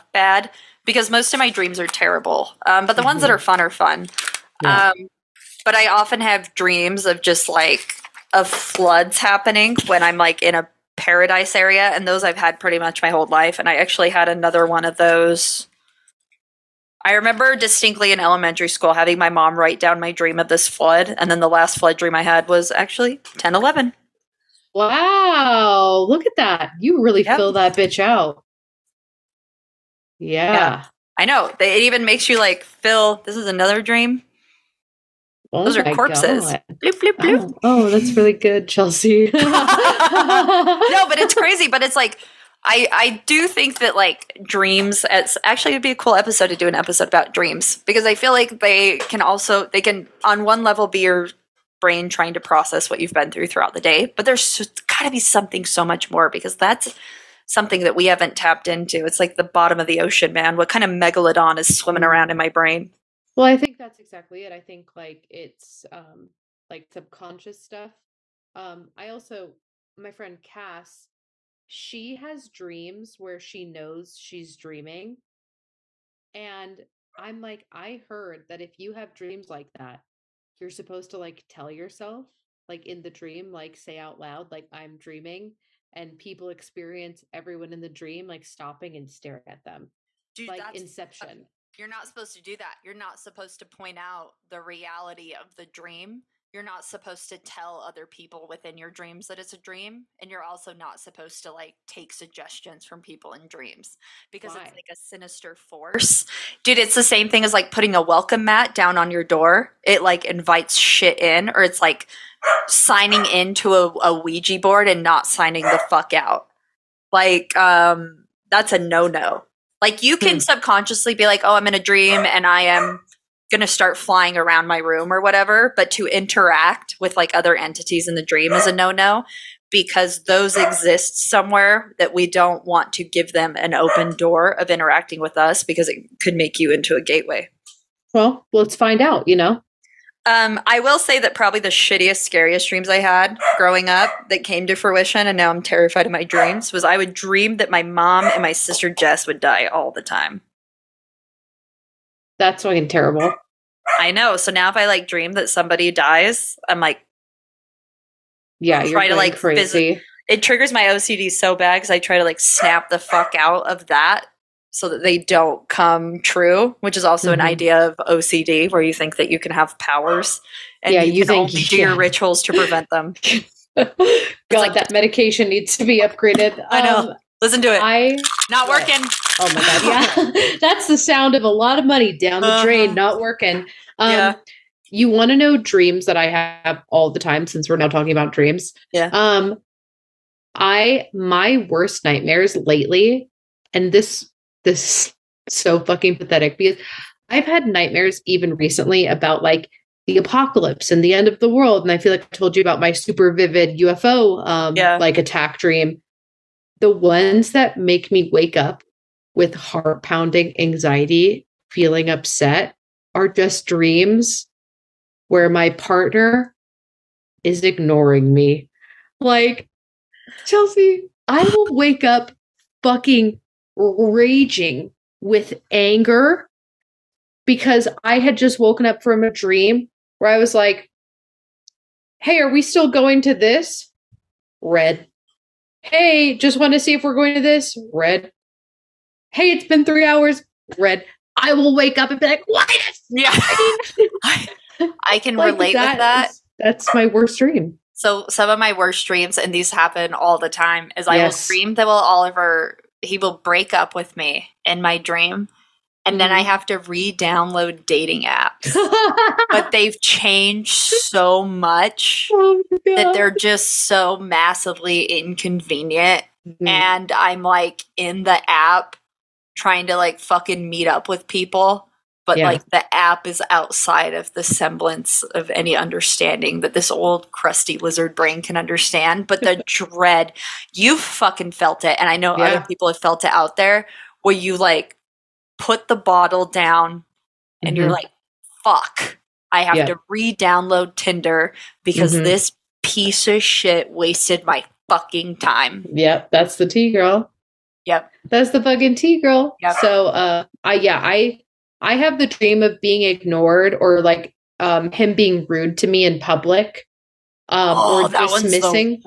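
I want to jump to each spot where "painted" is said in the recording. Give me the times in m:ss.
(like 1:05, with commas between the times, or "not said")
not said.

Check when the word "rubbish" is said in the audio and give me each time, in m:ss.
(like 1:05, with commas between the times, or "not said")
not said.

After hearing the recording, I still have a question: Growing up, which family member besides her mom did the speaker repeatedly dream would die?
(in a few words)
Jess.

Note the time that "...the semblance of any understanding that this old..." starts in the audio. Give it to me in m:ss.
4:34.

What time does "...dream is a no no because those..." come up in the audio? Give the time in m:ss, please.
2:08.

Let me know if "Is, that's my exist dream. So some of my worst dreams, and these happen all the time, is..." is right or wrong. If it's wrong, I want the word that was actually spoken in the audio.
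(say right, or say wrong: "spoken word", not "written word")
wrong: "worst", not "exist".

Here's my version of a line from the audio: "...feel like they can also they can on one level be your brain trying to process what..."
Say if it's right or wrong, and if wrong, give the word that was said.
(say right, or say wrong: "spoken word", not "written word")
right.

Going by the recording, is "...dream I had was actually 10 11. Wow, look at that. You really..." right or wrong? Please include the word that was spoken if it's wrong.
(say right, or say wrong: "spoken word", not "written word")
right.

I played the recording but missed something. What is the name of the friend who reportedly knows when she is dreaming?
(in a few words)
Cass.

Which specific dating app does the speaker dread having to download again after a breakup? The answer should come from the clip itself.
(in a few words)
Tinder.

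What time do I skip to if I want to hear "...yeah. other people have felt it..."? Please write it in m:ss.
4:42.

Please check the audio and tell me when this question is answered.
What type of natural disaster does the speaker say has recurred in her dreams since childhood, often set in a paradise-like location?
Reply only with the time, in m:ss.
0:08.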